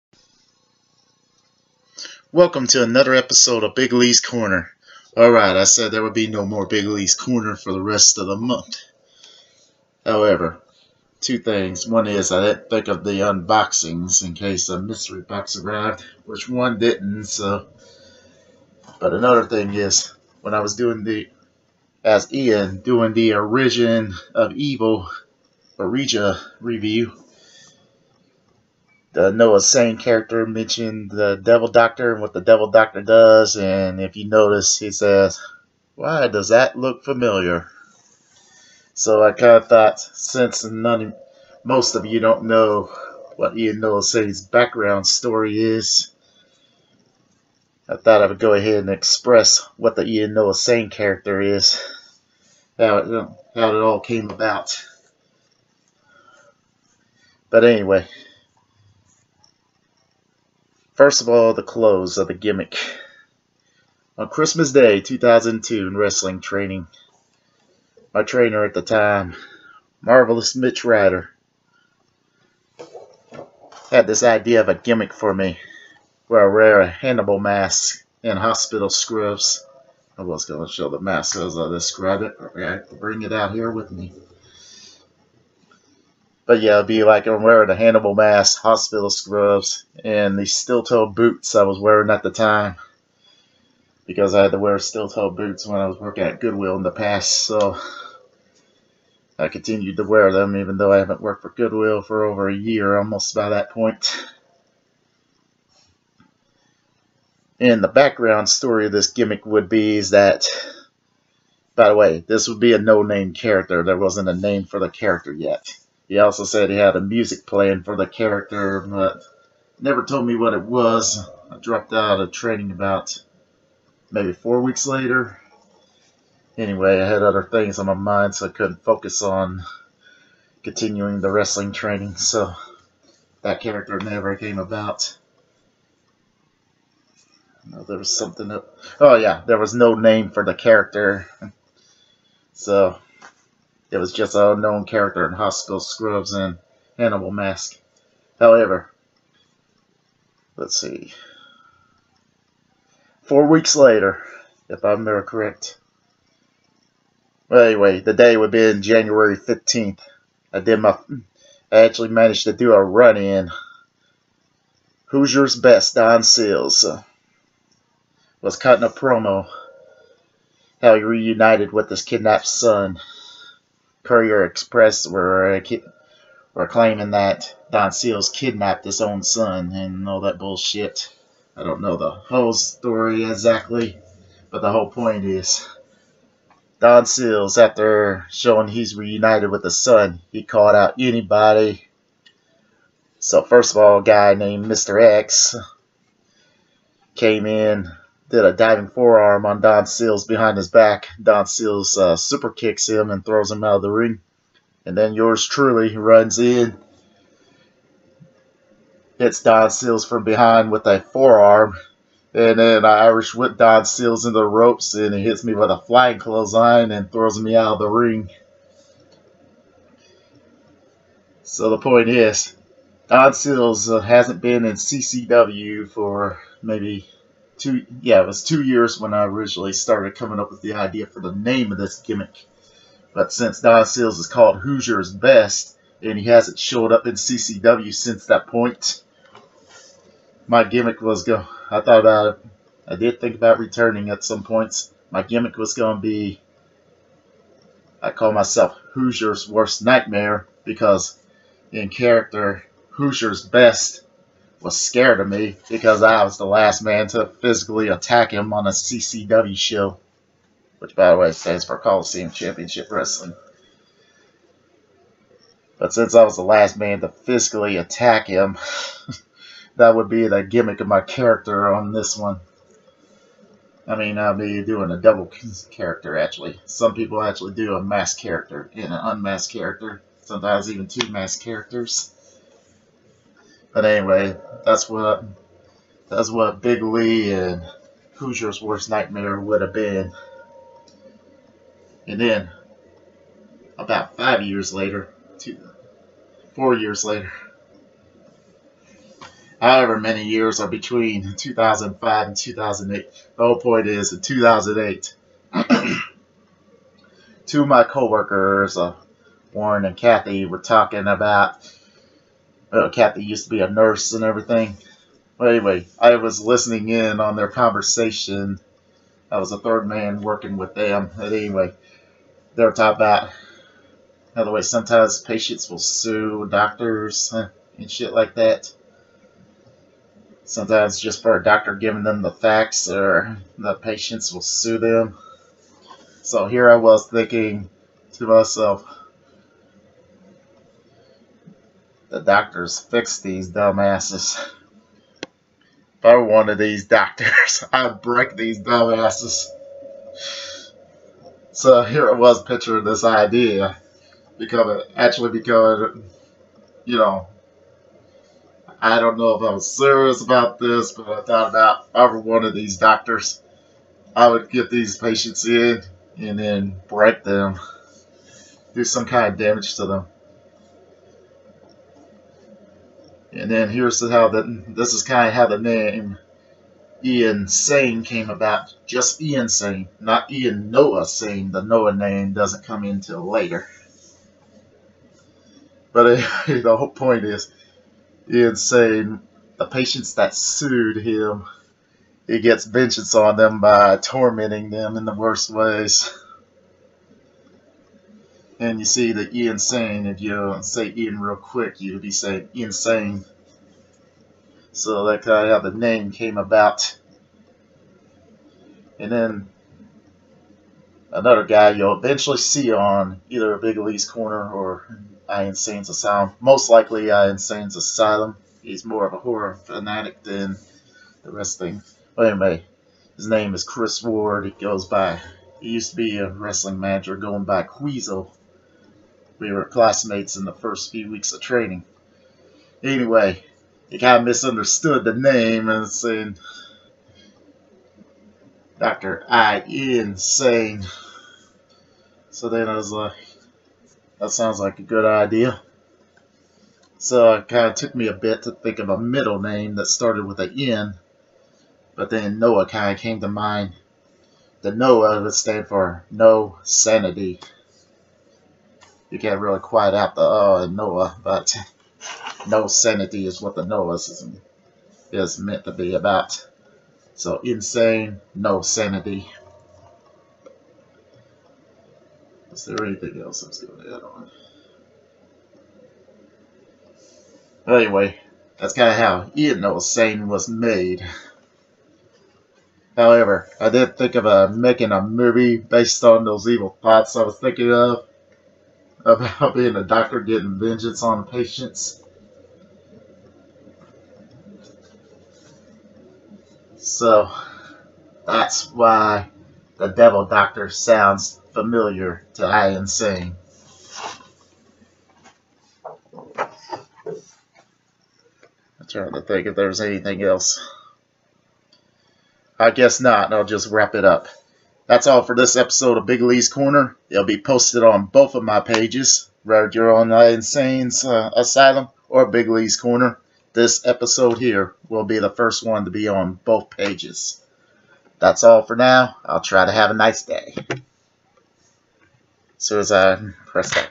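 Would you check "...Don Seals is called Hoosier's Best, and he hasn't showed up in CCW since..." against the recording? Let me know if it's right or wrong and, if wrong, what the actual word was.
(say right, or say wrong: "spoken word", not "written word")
right.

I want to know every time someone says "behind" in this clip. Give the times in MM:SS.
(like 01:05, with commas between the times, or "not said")
03:20, 03:30.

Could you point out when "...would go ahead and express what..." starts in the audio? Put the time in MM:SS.
00:48.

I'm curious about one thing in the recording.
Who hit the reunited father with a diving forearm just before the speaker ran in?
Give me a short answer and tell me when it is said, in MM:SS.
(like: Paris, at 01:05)
Mr. X, at 03:14.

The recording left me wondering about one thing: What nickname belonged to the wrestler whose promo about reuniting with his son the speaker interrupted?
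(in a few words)
Hoosiers best.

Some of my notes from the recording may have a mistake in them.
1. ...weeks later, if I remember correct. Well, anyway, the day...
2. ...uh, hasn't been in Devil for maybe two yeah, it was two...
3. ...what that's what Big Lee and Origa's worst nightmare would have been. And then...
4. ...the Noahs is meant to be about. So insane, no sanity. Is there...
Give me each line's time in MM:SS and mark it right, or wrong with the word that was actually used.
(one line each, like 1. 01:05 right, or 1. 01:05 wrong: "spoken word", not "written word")
1. 02:33 right
2. 03:43 wrong: "CCW", not "Devil"
3. 04:44 wrong: "Hoosier", not "Origa"
4. 07:43 right.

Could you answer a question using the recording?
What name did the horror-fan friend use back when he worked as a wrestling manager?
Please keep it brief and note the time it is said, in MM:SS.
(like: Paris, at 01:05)
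Queasel, at 07:07.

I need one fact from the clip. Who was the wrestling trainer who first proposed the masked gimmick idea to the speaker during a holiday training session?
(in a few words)
Marvelous Mitch Ryder.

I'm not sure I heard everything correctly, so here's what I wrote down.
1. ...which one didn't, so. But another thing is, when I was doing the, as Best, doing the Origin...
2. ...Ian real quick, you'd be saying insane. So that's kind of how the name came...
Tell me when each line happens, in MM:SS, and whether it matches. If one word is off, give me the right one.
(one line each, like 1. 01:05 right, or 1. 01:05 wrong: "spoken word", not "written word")
1. 00:16 wrong: "Ian", not "Best"
2. 06:40 right.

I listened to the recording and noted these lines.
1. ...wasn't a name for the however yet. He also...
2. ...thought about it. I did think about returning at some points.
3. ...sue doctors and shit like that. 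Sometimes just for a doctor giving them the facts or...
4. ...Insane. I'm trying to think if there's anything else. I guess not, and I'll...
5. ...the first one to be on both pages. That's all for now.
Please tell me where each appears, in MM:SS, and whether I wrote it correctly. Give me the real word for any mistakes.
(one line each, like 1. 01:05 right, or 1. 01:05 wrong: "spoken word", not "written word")
1. 01:53 wrong: "character", not "however"
2. 04:01 right
3. 05:25 right
4. 08:22 right
5. 08:45 right.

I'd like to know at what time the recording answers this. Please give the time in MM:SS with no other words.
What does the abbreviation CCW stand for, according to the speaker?
04:21.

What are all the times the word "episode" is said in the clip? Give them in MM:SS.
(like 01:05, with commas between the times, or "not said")
00:03, 08:35, 08:43.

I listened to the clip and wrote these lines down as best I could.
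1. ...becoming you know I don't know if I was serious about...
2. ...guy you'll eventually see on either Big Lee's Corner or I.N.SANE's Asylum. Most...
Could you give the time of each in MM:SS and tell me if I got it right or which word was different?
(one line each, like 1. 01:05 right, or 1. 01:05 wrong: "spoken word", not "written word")
1. 05:55 right
2. 06:51 right.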